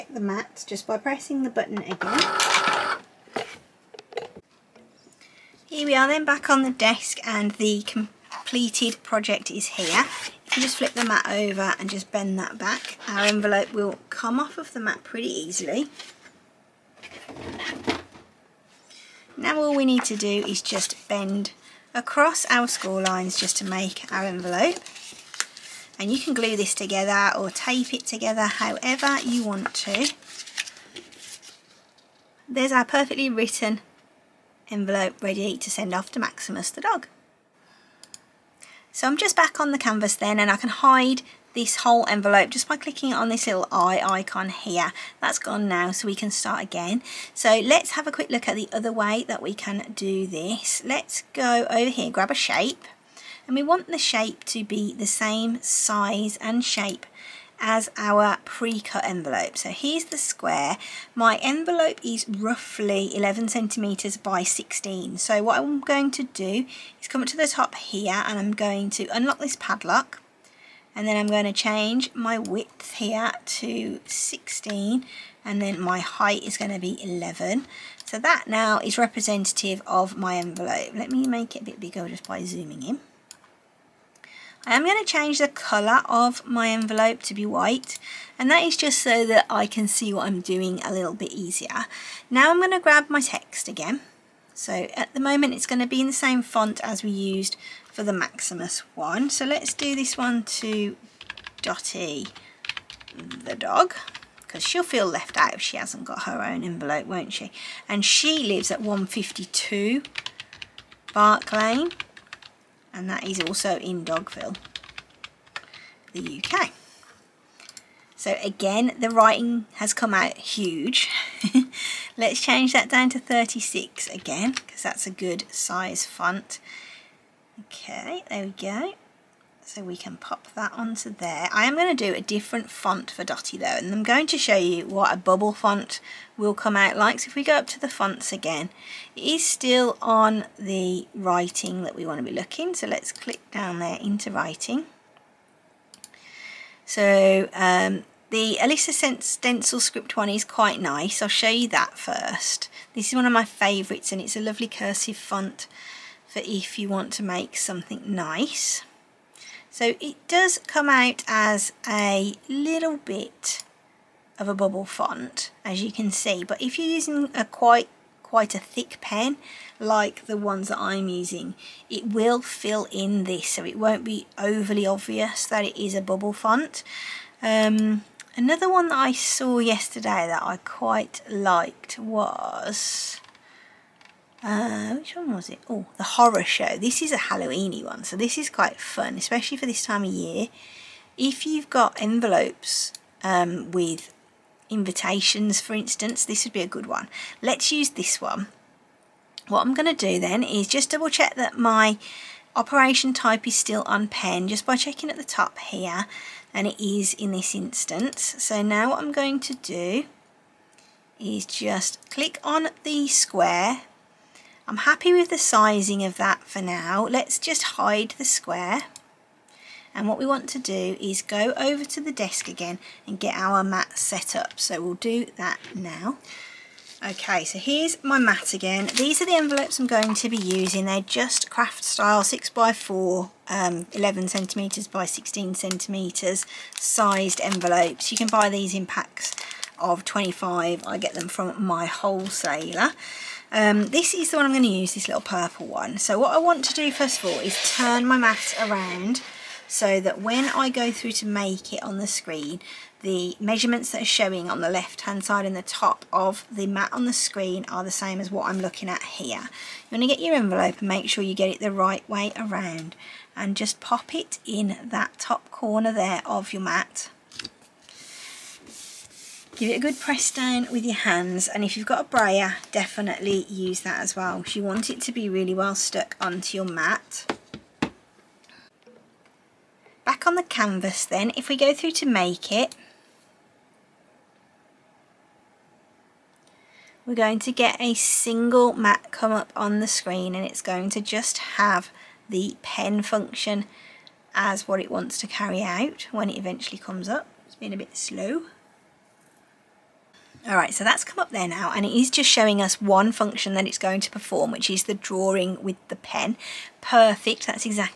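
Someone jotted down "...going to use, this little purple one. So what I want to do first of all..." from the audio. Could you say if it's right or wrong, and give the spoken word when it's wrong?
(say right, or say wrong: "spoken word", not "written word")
right.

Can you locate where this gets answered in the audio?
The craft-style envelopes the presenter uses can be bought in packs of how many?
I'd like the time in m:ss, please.
4:00.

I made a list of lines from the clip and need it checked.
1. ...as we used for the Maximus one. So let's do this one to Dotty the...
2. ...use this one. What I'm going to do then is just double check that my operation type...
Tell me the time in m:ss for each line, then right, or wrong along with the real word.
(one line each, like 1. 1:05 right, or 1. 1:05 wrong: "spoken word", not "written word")
1. 1:36 right
2. 3:17 right.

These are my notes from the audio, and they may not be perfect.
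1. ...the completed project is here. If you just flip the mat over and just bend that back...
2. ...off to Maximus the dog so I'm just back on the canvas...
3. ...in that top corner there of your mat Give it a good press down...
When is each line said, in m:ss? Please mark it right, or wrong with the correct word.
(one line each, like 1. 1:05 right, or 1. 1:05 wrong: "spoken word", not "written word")
1. 0:07 right
2. 0:35 right
3. 4:24 right.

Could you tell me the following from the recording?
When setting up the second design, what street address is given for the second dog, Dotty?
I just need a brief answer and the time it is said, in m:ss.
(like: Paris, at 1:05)
152 Bark Lane, at 1:48.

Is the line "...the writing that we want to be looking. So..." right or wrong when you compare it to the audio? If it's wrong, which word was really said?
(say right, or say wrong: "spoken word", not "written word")
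right.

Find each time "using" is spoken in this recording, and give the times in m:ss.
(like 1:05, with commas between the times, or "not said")
2:46, 2:51, 3:50.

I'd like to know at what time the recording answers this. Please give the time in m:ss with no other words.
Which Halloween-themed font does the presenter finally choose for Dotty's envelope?
3:05.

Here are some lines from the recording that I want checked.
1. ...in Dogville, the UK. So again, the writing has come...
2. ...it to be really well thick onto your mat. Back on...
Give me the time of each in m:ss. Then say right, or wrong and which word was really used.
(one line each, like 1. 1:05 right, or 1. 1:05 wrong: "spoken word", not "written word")
1. 1:53 right
2. 4:34 wrong: "stuck", not "thick".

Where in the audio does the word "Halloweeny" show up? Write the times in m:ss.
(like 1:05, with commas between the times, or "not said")
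3:07.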